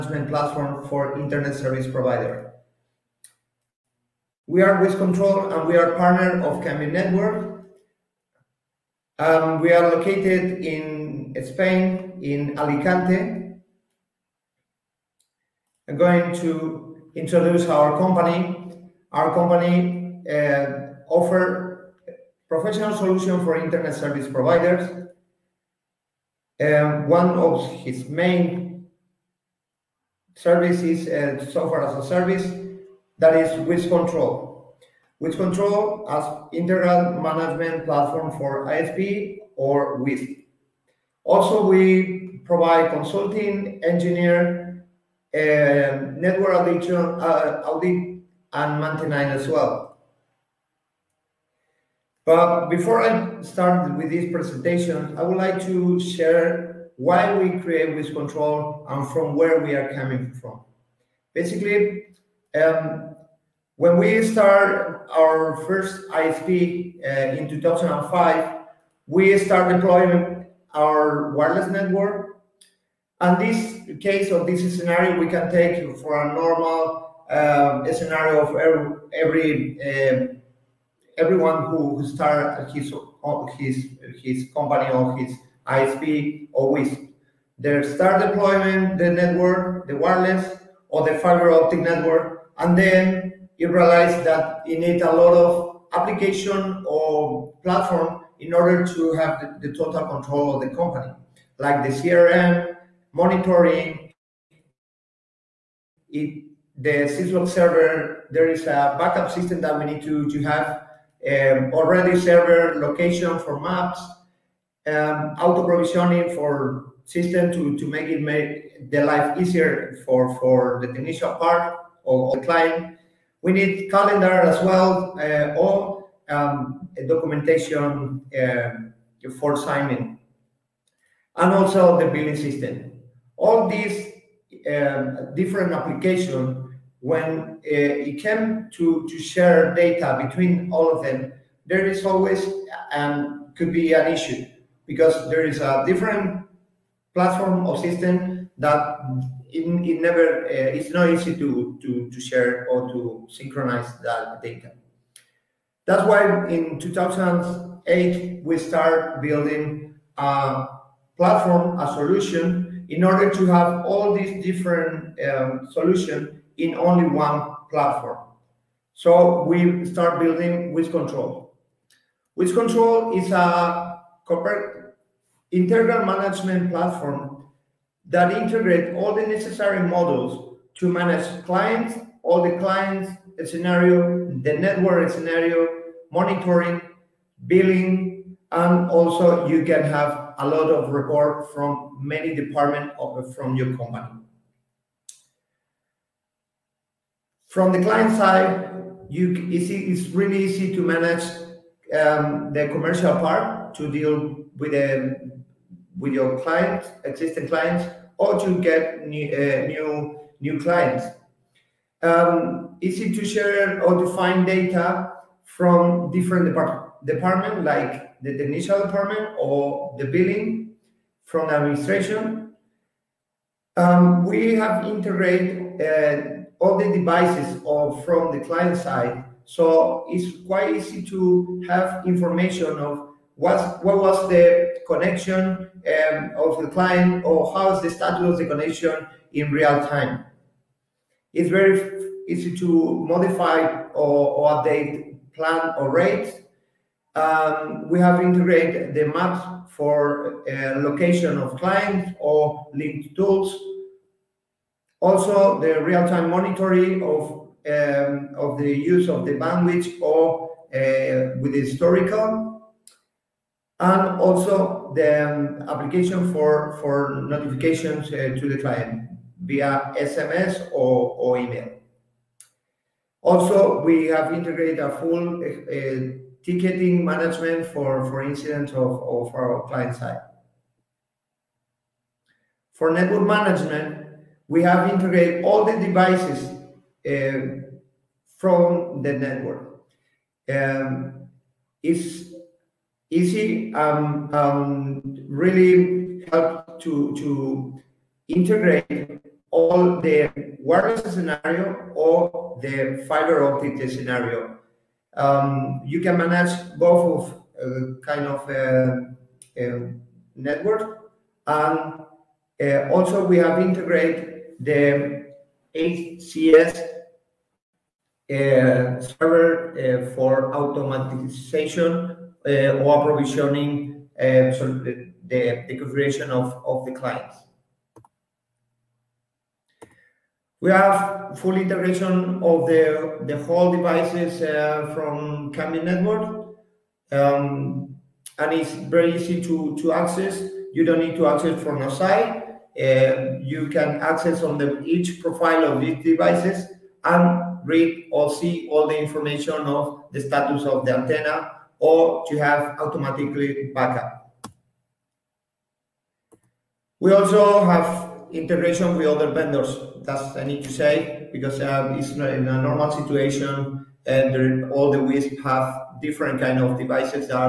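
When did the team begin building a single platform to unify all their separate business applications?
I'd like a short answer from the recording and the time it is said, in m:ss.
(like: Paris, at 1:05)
2008, at 2:36.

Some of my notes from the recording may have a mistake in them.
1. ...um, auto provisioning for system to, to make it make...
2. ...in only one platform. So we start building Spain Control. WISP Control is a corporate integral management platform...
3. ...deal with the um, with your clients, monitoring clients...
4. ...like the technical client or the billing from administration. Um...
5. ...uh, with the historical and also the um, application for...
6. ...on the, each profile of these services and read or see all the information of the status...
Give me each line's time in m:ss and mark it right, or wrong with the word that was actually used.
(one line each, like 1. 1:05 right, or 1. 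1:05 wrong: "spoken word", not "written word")
1. 1:54 right
2. 2:46 wrong: "WISP", not "Spain"
3. 3:23 wrong: "existing", not "monitoring"
4. 3:37 wrong: "department", not "client"
5. 4:20 right
6. 5:44 wrong: "devices", not "services".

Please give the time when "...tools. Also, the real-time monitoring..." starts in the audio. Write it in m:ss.
4:13.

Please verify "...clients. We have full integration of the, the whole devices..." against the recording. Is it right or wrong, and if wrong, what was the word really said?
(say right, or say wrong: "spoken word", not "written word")
right.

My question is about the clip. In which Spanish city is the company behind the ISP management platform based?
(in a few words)
Alicante.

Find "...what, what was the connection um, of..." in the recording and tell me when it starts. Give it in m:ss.
3:53.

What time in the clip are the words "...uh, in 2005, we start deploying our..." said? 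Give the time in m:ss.
1:06.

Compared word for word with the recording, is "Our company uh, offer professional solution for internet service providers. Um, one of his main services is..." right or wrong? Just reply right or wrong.
right.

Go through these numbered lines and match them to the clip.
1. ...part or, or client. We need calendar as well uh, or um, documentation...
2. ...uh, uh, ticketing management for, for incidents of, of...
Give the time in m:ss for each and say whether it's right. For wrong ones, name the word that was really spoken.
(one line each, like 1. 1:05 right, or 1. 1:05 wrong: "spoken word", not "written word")
1. 2:01 right
2. 4:35 right.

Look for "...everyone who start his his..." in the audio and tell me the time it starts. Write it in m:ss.
1:21.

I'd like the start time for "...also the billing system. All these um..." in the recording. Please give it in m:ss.
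2:11.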